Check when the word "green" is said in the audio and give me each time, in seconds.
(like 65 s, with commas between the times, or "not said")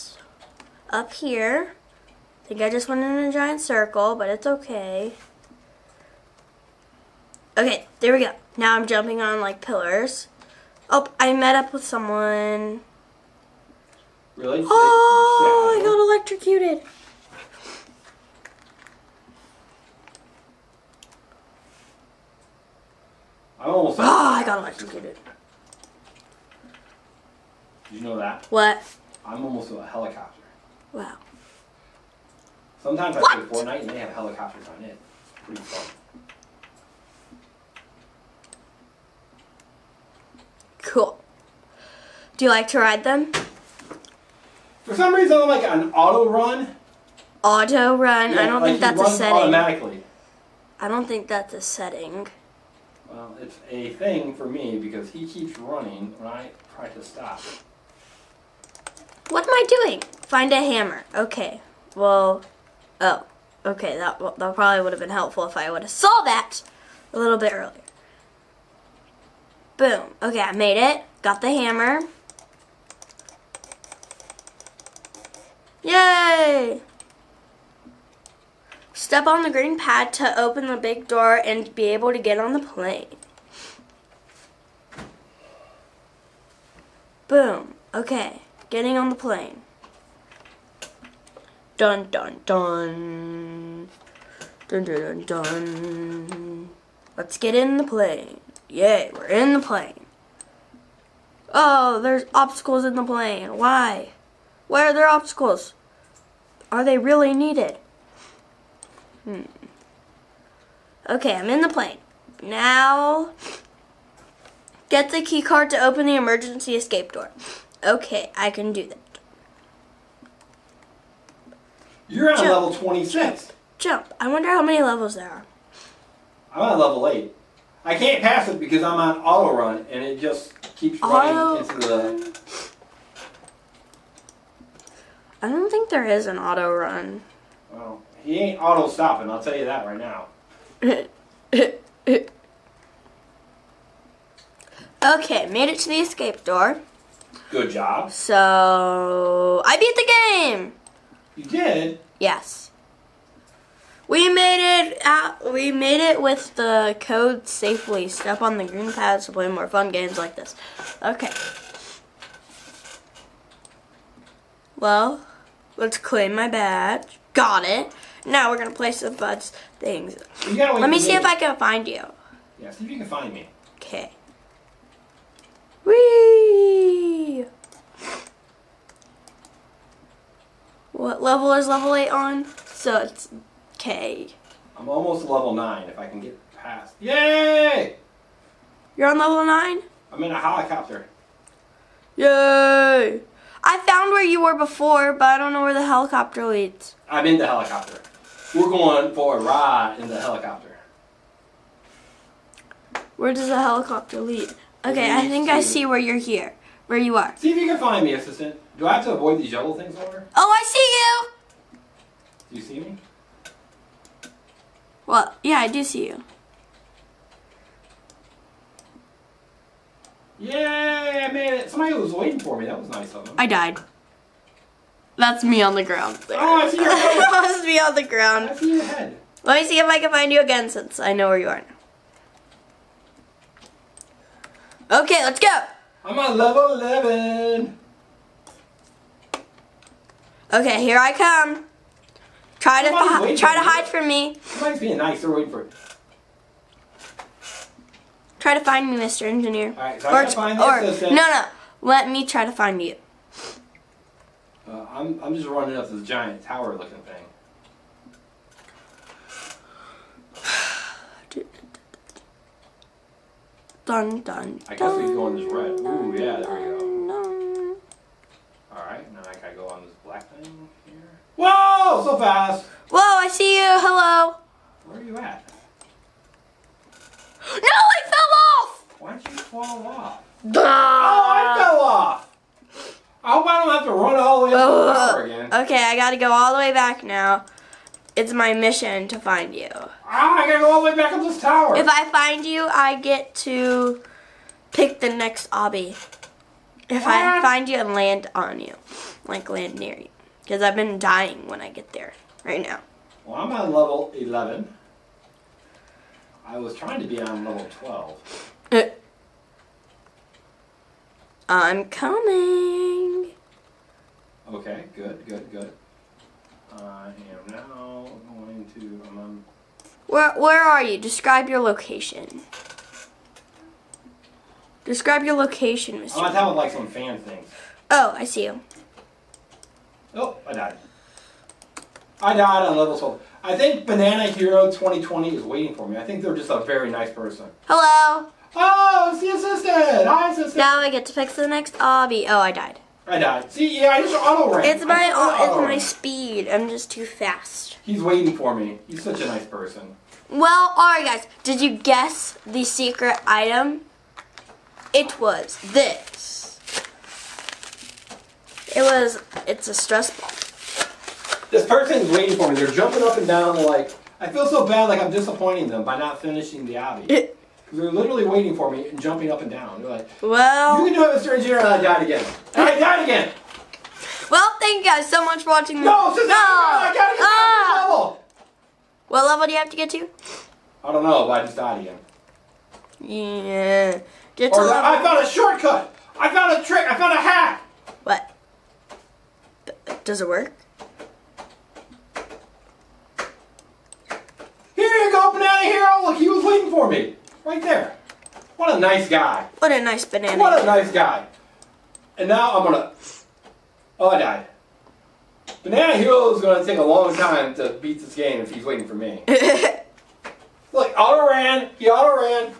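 79 s, 158 s.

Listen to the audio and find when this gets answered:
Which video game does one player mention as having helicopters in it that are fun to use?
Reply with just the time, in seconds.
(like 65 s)
33 s.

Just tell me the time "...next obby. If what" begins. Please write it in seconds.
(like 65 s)
295 s.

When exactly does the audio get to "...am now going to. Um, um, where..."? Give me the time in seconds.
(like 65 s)
317 s.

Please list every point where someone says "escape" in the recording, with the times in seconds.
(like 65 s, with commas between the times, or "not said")
116 s, 145 s.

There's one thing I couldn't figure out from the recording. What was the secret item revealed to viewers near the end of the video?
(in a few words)
A stress ball.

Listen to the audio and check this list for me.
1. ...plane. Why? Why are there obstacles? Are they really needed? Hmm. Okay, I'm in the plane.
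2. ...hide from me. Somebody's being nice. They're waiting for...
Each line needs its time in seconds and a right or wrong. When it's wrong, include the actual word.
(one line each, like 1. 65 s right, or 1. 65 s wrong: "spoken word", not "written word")
1. 103 s right
2. 243 s right.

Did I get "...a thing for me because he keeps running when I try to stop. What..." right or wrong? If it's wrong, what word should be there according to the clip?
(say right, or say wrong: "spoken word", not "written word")
right.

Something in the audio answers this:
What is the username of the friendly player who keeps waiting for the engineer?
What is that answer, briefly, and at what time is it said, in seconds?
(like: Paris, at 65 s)
Banana Hero 2020, at 333 s.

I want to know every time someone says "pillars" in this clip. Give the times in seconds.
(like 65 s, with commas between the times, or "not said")
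9 s.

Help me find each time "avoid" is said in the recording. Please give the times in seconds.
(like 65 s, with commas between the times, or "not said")
209 s.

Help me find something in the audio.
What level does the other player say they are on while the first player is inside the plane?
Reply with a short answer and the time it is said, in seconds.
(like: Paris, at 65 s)
26, at 122 s.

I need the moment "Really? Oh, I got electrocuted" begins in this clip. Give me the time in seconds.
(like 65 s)
14 s.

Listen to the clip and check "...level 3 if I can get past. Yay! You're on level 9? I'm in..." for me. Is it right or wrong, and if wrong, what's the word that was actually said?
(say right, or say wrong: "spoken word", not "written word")
wrong: "9", not "3".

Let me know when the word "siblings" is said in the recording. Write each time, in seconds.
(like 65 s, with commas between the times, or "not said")
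not said.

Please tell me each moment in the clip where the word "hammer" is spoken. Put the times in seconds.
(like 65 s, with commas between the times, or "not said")
60 s, 71 s.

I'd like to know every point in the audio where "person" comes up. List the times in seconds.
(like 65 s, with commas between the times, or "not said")
337 s, 349 s, 361 s.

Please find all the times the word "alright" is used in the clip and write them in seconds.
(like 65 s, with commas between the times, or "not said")
268 s, 350 s.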